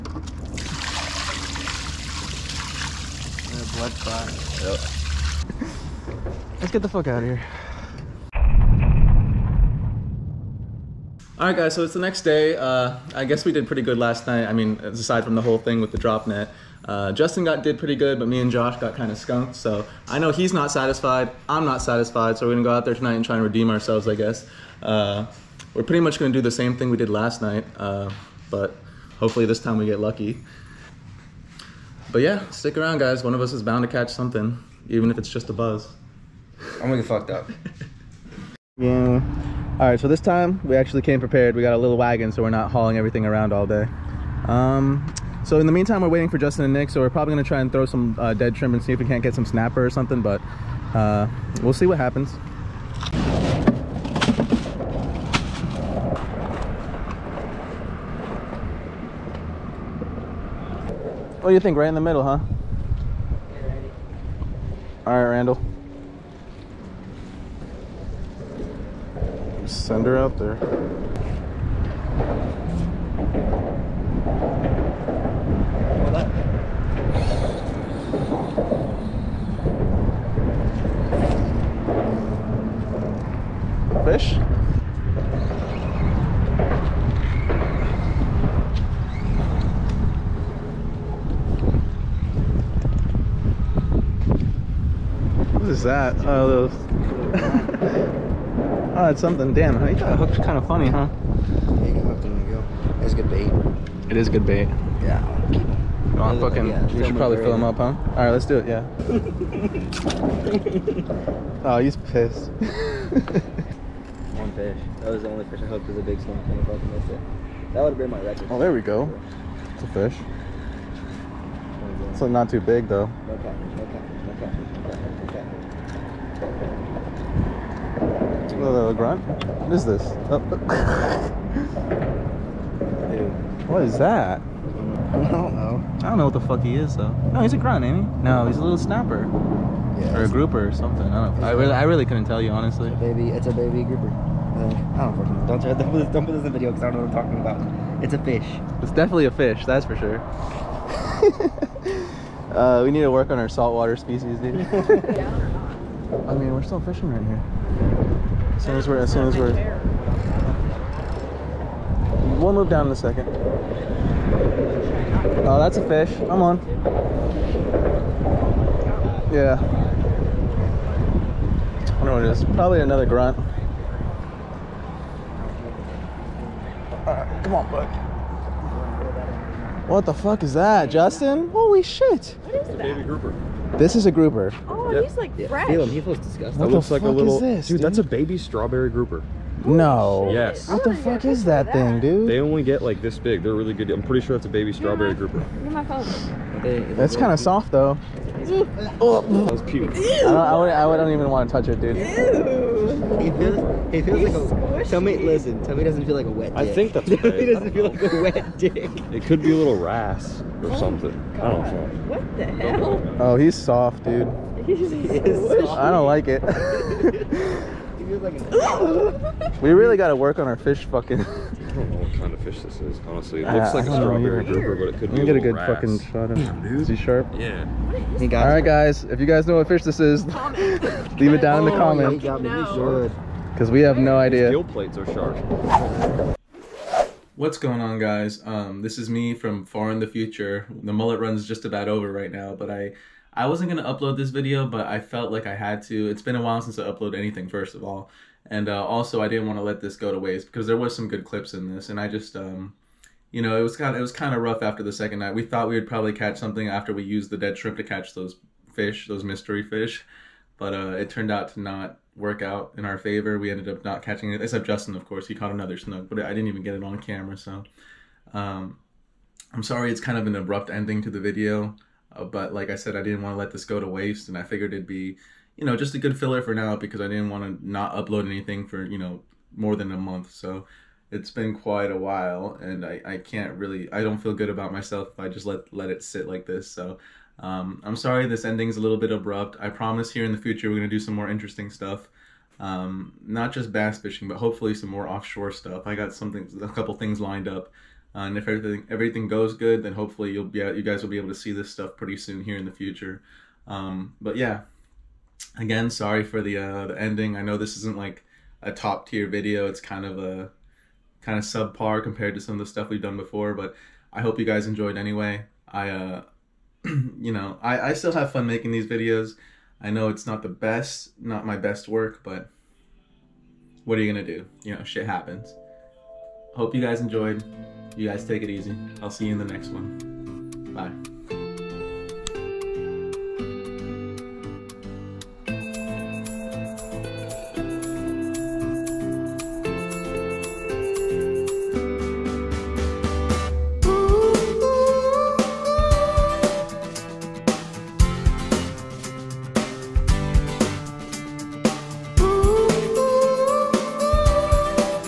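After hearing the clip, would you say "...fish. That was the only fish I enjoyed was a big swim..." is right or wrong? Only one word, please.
wrong.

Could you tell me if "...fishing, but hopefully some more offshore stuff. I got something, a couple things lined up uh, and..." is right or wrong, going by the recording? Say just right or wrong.
right.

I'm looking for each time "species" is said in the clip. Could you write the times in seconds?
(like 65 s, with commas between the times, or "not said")
153 s.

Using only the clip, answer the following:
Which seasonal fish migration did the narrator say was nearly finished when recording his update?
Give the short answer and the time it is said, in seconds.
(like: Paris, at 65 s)
mullet run, at 240 s.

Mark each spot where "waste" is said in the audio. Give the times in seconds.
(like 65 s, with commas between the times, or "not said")
250 s, 273 s.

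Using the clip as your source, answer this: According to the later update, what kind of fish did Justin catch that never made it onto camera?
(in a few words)
snook.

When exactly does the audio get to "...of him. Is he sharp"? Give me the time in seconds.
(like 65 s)
226 s.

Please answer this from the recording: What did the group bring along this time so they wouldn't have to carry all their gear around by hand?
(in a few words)
a little wagon.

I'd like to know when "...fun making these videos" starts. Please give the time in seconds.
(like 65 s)
318 s.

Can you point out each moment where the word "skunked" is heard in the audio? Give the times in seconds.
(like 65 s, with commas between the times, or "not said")
19 s.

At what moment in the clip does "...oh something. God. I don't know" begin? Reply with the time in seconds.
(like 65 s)
210 s.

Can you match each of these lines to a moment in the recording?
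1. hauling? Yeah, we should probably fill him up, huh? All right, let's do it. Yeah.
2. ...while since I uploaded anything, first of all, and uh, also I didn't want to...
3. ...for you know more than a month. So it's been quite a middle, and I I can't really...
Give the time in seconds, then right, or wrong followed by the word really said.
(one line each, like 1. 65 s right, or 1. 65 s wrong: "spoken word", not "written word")
1. 106 s wrong: "fucking", not "hauling"
2. 246 s right
3. 278 s wrong: "while", not "middle".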